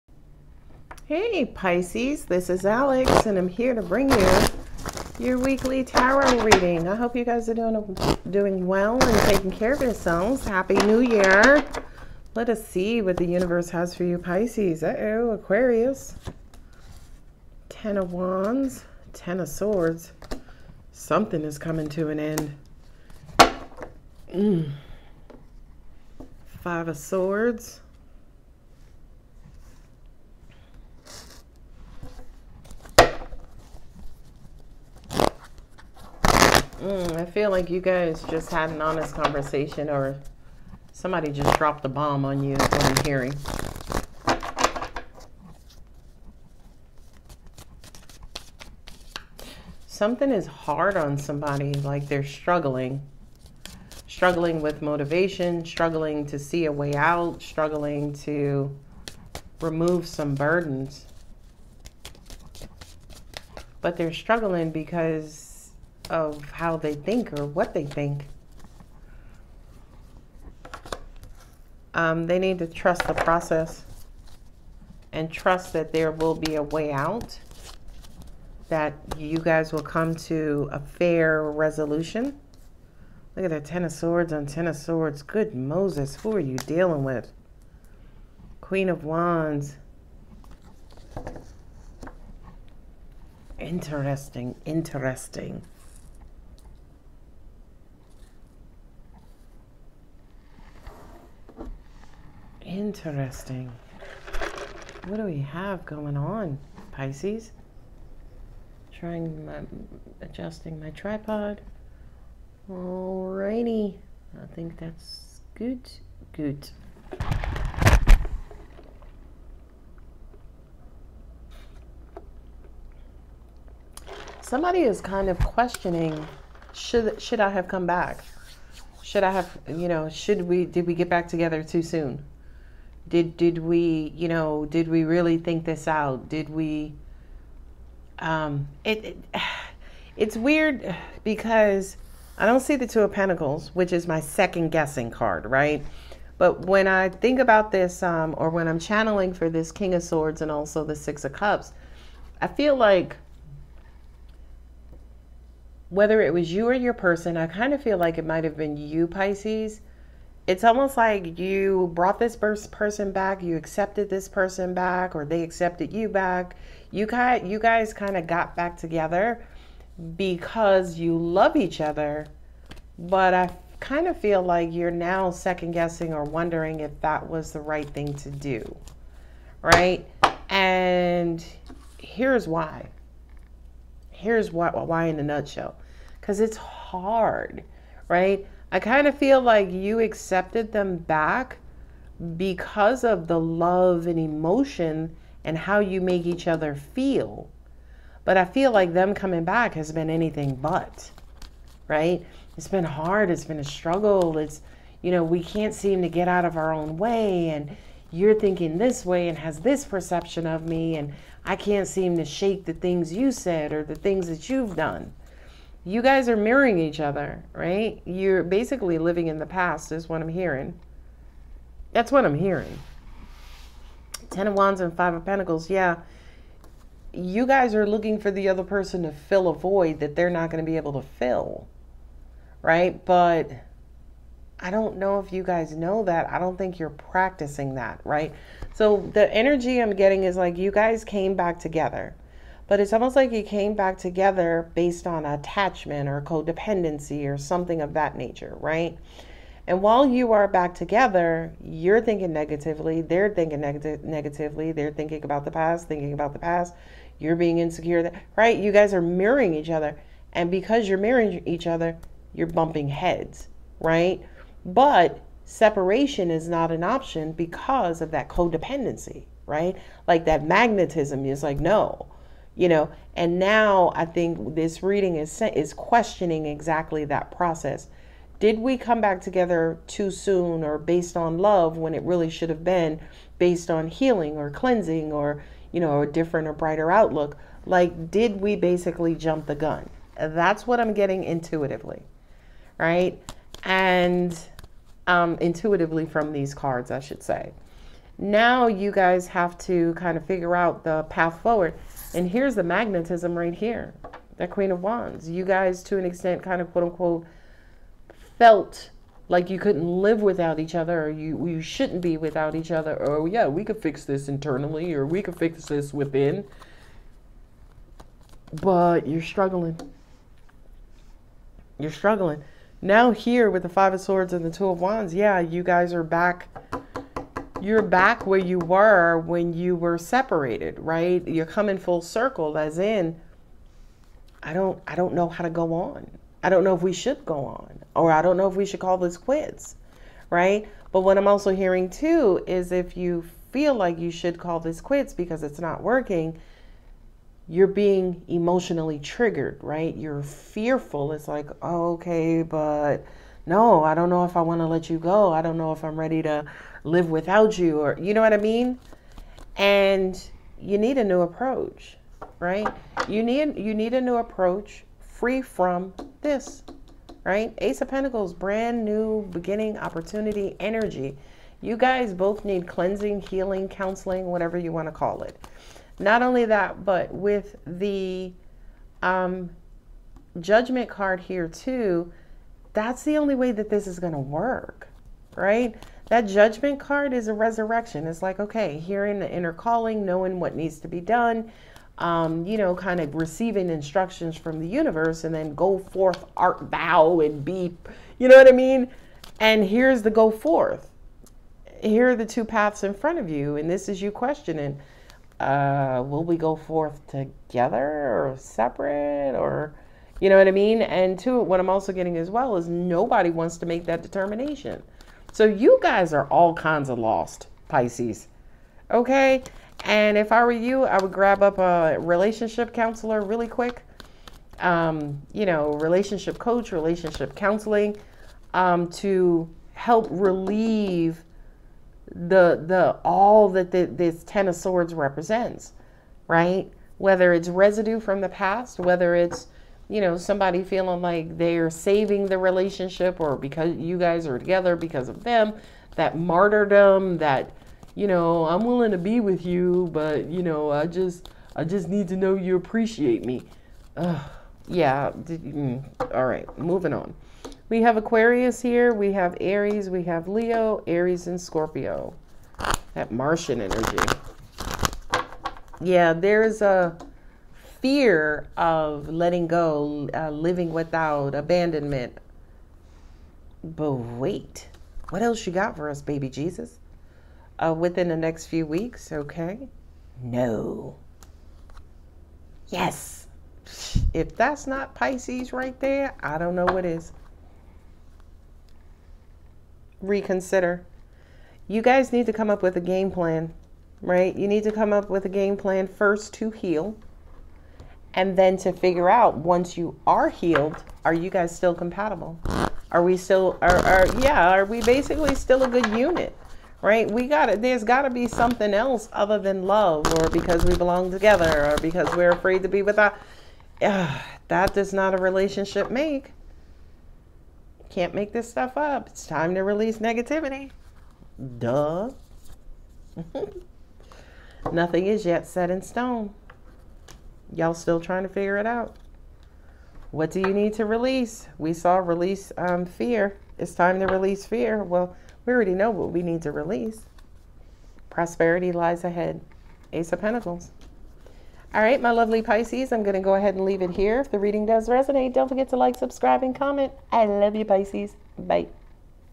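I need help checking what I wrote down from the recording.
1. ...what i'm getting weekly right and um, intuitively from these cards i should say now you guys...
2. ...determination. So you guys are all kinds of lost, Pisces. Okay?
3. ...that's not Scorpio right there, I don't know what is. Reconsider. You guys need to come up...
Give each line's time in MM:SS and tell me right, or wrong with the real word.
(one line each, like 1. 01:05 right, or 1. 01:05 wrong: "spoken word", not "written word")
1. 04:50 wrong: "intuitively", not "weekly"
2. 06:54 right
3. 08:04 wrong: "Pisces", not "Scorpio".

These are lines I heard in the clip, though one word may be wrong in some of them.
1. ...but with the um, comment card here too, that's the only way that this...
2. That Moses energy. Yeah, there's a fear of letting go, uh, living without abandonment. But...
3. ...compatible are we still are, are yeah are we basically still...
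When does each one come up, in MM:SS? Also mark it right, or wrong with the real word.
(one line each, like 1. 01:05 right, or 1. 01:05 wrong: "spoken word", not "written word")
1. 06:16 wrong: "judgment", not "comment"
2. 07:42 wrong: "Martian", not "Moses"
3. 08:21 right.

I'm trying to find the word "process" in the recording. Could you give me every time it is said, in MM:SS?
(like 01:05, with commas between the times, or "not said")
01:13, 04:37.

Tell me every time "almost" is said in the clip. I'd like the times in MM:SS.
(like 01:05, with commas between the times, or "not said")
02:40, 04:02.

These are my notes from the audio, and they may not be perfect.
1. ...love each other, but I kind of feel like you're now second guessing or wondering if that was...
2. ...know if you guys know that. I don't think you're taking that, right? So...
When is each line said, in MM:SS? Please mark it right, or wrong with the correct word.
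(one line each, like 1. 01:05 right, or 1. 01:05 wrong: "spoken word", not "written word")
1. 02:51 right
2. 03:54 wrong: "practicing", not "taking".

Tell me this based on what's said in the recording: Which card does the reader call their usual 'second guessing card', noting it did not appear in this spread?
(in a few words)
Two of Pentacles.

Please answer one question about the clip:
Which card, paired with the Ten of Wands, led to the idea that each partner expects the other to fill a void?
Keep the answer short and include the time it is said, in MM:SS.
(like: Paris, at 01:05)
Five of Pentacles, at 03:44.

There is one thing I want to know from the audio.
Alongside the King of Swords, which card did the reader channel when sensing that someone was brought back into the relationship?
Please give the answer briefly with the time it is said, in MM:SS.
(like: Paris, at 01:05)
Six of Cups, at 02:30.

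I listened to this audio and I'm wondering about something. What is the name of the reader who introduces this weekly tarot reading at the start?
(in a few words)
Alex.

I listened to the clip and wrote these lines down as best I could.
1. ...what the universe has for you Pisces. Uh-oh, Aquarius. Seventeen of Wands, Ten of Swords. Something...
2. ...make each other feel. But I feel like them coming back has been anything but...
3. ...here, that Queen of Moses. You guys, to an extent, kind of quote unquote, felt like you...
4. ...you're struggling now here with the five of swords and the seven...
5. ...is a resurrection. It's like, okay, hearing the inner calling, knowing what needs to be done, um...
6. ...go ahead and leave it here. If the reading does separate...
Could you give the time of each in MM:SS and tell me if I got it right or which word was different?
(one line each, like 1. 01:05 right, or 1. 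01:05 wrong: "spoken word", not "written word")
1. 00:13 wrong: "Ten", not "Seventeen"
2. 03:15 right
3. 05:03 wrong: "Wands", not "Moses"
4. 05:21 wrong: "two", not "seven"
5. 06:27 right
6. 09:03 wrong: "resonate", not "separate".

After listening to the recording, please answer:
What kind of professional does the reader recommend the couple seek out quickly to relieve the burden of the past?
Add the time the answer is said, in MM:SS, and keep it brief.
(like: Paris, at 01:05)
Relationship counselor, at 07:01.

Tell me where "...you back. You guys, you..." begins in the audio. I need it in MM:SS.
02:45.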